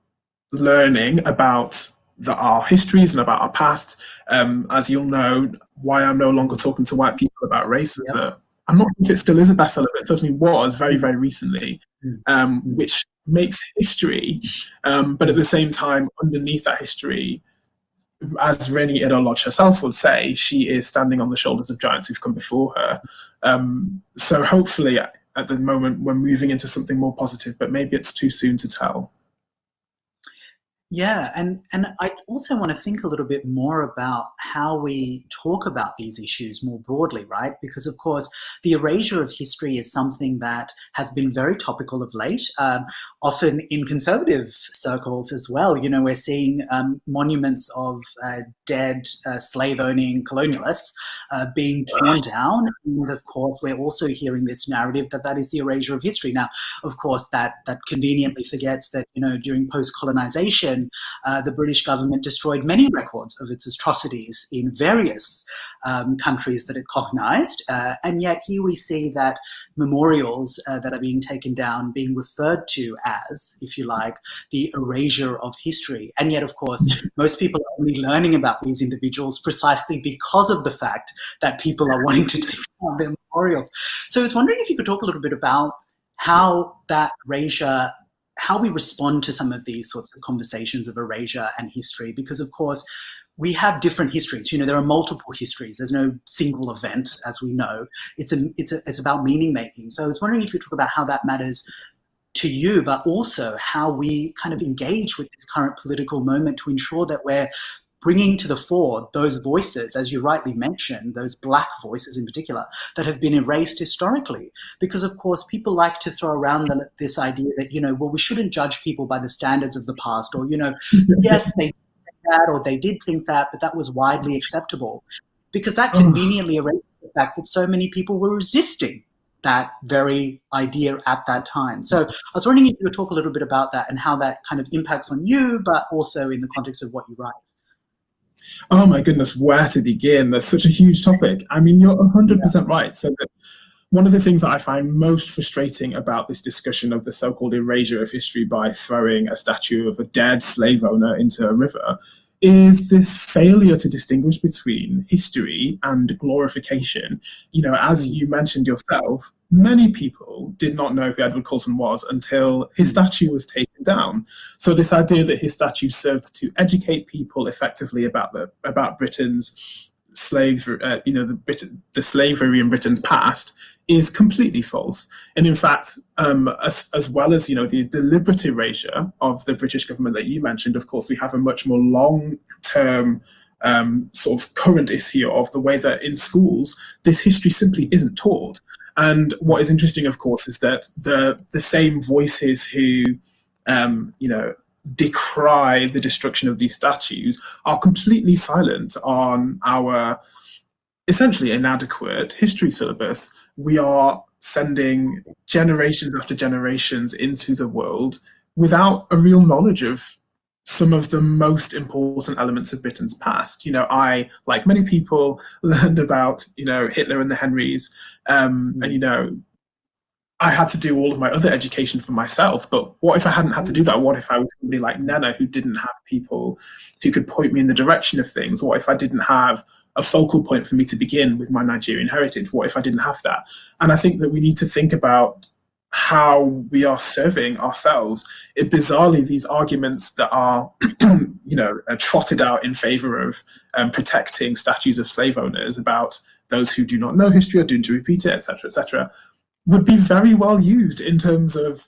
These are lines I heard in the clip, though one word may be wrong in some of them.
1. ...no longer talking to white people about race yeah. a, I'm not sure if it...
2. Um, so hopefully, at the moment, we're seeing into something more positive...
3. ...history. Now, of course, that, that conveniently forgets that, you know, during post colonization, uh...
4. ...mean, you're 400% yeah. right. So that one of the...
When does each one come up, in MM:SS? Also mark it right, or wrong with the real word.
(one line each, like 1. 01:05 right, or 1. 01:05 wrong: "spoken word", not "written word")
1. 00:06 right
2. 00:23 wrong: "moving", not "seeing"
3. 00:56 right
4. 02:21 wrong: "100", not "400".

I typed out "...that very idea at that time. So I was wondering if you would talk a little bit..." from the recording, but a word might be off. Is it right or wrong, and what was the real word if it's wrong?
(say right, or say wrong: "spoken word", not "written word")
right.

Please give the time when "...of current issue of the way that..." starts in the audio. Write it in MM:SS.
03:04.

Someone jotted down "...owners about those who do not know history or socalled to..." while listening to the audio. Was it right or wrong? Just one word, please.
wrong.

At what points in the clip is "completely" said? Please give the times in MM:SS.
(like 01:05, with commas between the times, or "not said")
02:54, 03:17.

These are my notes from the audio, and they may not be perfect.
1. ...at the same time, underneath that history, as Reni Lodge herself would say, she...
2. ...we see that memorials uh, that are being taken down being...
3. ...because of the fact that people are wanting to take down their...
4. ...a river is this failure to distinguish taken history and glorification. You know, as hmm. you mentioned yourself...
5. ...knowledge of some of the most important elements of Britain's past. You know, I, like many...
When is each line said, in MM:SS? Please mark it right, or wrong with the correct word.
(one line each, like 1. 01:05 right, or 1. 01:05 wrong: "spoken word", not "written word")
1. 00:15 right
2. 01:08 right
3. 01:20 right
4. 02:31 wrong: "between", not "taken"
5. 03:29 right.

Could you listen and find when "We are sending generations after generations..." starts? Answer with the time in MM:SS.
03:23.